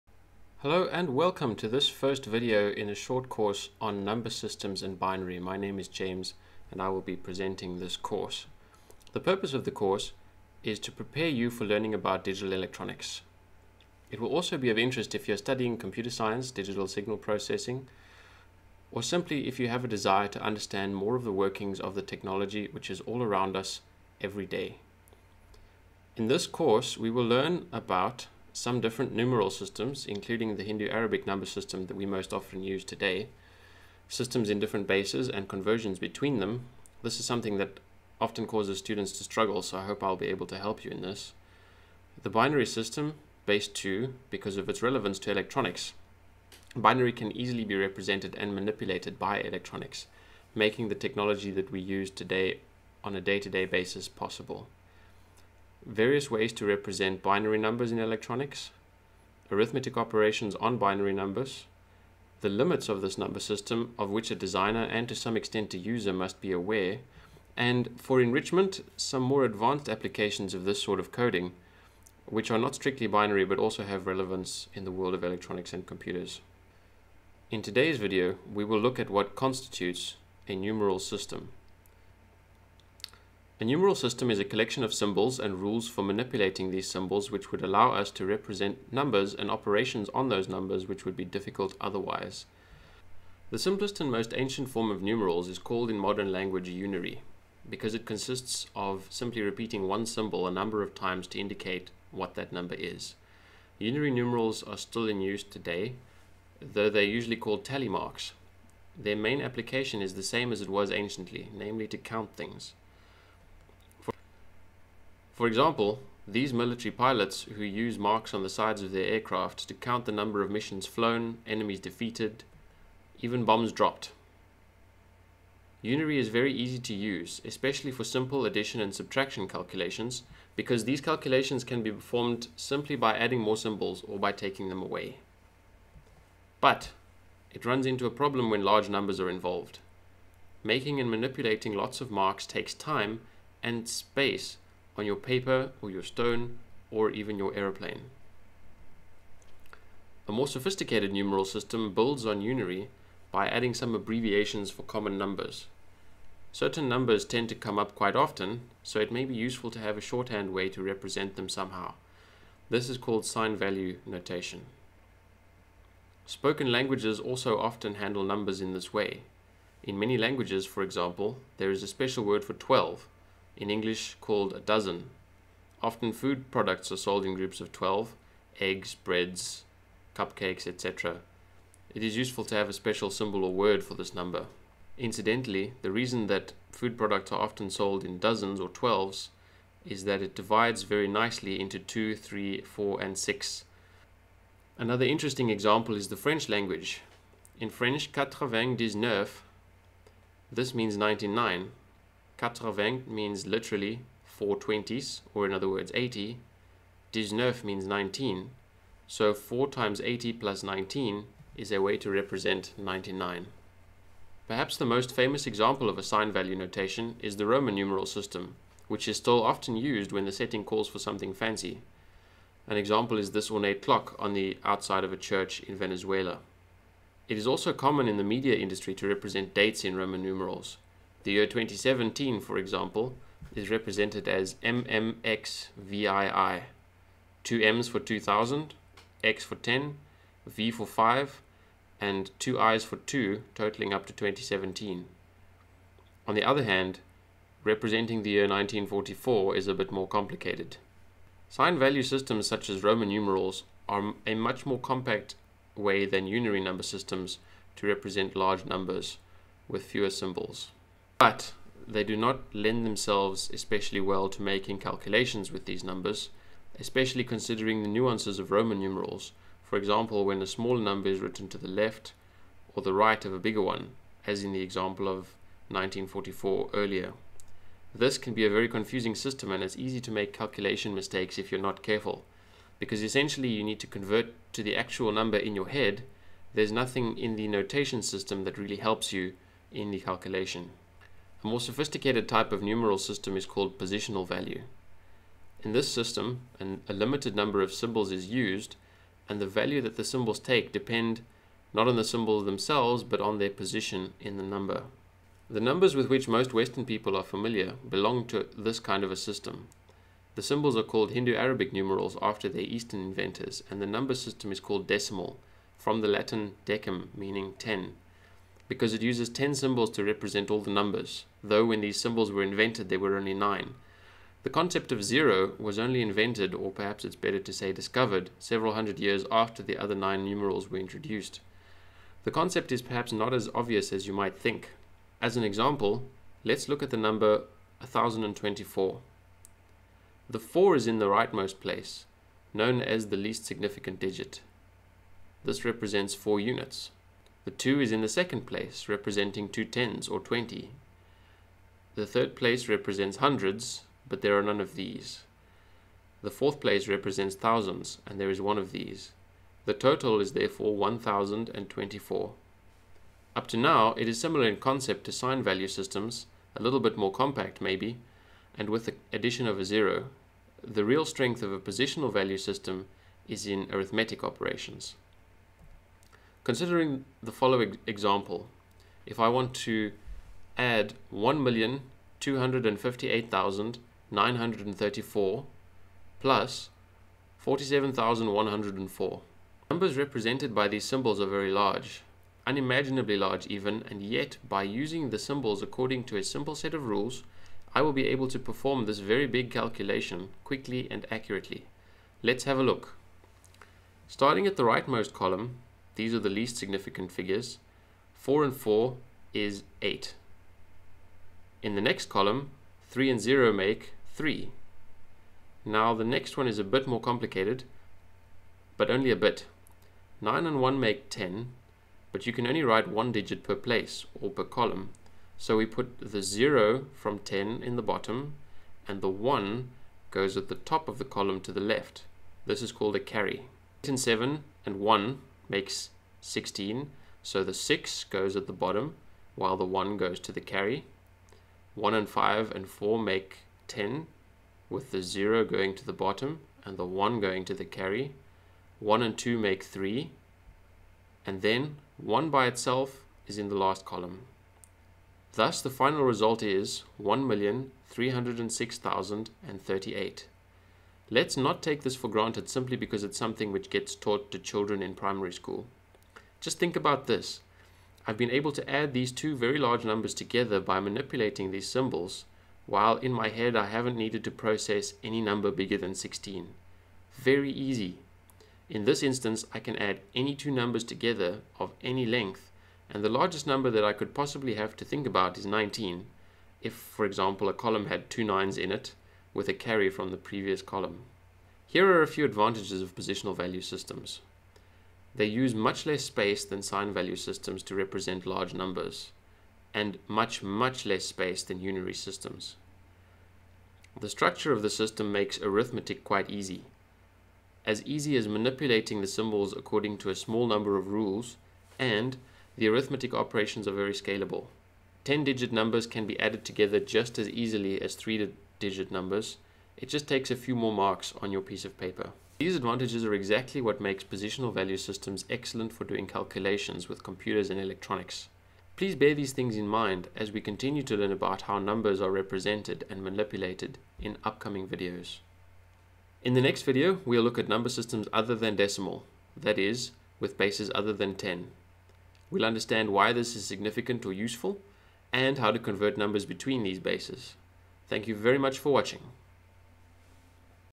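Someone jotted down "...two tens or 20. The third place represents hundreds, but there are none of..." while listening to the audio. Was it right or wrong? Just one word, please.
right.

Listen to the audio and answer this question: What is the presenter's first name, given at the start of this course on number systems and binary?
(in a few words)
James.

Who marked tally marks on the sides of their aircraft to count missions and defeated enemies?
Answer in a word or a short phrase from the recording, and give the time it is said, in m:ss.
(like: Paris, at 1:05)
Military pilots, at 1:56.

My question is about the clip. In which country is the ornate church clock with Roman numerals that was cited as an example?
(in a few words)
Venezuela.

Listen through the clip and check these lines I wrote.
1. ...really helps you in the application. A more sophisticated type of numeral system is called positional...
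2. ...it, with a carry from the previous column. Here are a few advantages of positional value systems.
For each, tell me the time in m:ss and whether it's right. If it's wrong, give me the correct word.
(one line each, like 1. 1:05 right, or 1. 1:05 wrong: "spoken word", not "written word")
1. 4:48 wrong: "calculation", not "application"
2. 8:08 right.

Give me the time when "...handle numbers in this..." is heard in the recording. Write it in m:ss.
2:47.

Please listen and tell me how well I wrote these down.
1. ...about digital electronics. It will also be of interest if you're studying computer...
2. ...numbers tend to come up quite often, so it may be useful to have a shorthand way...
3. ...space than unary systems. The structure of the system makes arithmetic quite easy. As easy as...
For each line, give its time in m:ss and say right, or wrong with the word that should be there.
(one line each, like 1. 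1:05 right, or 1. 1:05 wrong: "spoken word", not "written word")
1. 0:11 right
2. 2:36 right
3. 8:21 right.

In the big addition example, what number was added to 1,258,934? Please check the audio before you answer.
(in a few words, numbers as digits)
47,104.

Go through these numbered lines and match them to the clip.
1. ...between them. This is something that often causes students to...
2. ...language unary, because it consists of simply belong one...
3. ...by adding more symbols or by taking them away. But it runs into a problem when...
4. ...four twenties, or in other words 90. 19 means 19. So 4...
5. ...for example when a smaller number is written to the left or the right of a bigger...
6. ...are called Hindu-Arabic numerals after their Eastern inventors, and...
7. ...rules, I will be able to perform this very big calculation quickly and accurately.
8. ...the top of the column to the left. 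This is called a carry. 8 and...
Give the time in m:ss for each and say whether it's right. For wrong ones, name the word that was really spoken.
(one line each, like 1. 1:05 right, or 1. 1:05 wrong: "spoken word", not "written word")
1. 0:35 right
2. 1:36 wrong: "repeating", not "belong"
3. 2:12 right
4. 3:24 wrong: "80", not "90"
5. 4:29 right
6. 5:10 right
7. 6:36 right
8. 7:10 right.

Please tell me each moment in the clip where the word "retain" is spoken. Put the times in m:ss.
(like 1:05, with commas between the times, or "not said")
not said.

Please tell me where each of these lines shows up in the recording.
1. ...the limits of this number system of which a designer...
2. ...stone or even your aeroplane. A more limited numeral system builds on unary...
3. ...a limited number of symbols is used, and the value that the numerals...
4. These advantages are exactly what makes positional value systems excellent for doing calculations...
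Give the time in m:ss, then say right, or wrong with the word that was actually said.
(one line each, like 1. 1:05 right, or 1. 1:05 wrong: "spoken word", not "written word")
1. 1:02 right
2. 2:26 wrong: "sophisticated", not "limited"
3. 4:56 wrong: "symbols", not "numerals"
4. 8:42 right.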